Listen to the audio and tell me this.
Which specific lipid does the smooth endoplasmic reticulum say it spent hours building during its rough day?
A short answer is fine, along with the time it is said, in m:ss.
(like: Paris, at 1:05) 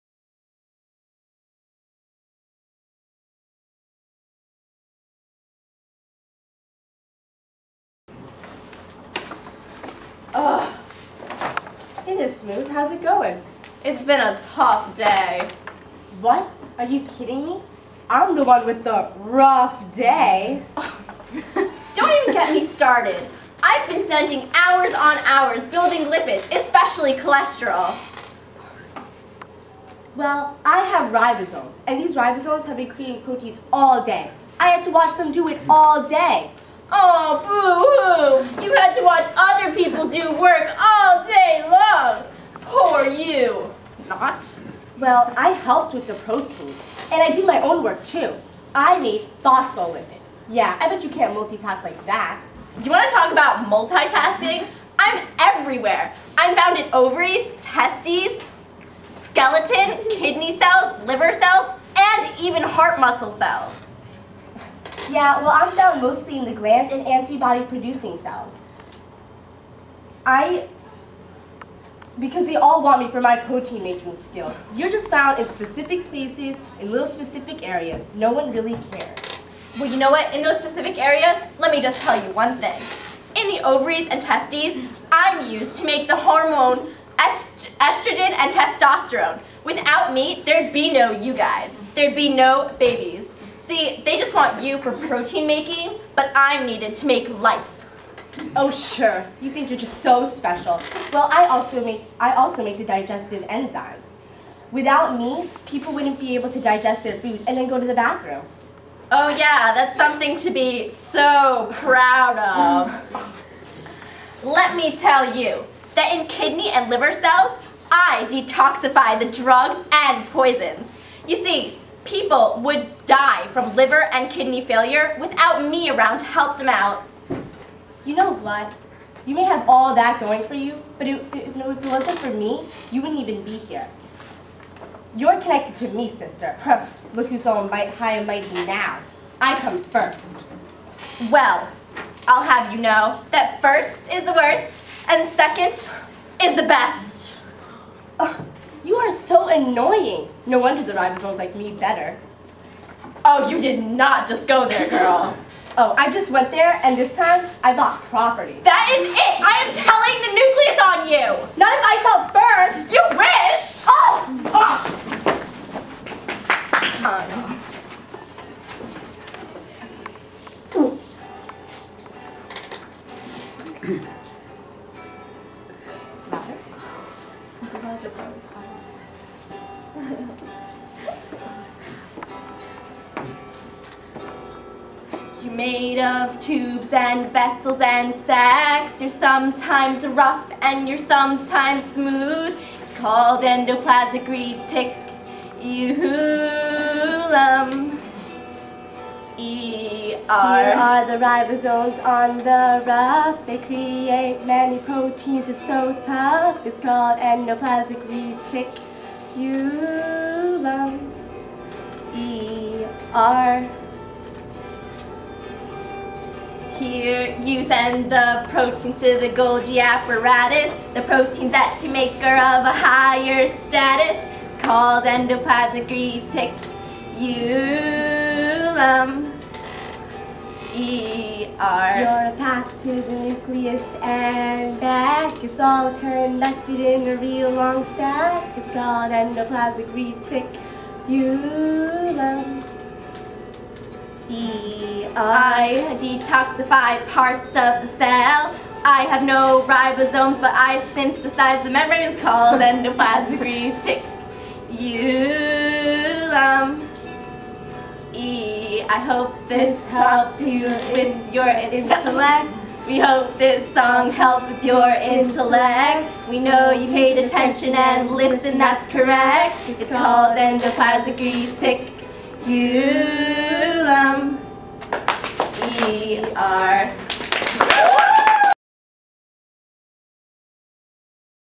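Cholesterol, at 0:27.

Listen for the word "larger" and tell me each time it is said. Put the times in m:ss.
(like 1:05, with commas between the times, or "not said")
not said.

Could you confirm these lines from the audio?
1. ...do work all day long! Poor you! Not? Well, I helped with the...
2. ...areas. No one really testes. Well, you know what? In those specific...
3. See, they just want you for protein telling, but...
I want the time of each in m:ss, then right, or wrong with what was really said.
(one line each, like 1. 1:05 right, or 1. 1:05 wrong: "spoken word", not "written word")
1. 0:40 right
2. 1:17 wrong: "cares", not "testes"
3. 1:33 wrong: "making", not "telling".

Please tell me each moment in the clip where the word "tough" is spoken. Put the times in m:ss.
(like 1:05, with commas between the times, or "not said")
0:14, 3:26.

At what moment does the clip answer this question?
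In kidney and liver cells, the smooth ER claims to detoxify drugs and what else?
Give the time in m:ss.
2:00.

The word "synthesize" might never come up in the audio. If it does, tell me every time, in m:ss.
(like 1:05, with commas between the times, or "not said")
4:10.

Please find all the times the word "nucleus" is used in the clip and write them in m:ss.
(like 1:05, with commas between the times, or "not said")
2:40, 3:53.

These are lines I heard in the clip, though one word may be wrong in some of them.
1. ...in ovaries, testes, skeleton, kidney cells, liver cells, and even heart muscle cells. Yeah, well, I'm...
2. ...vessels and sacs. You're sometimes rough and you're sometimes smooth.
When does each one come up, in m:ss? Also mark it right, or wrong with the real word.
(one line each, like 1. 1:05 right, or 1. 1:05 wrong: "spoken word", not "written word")
1. 0:56 right
2. 3:07 right.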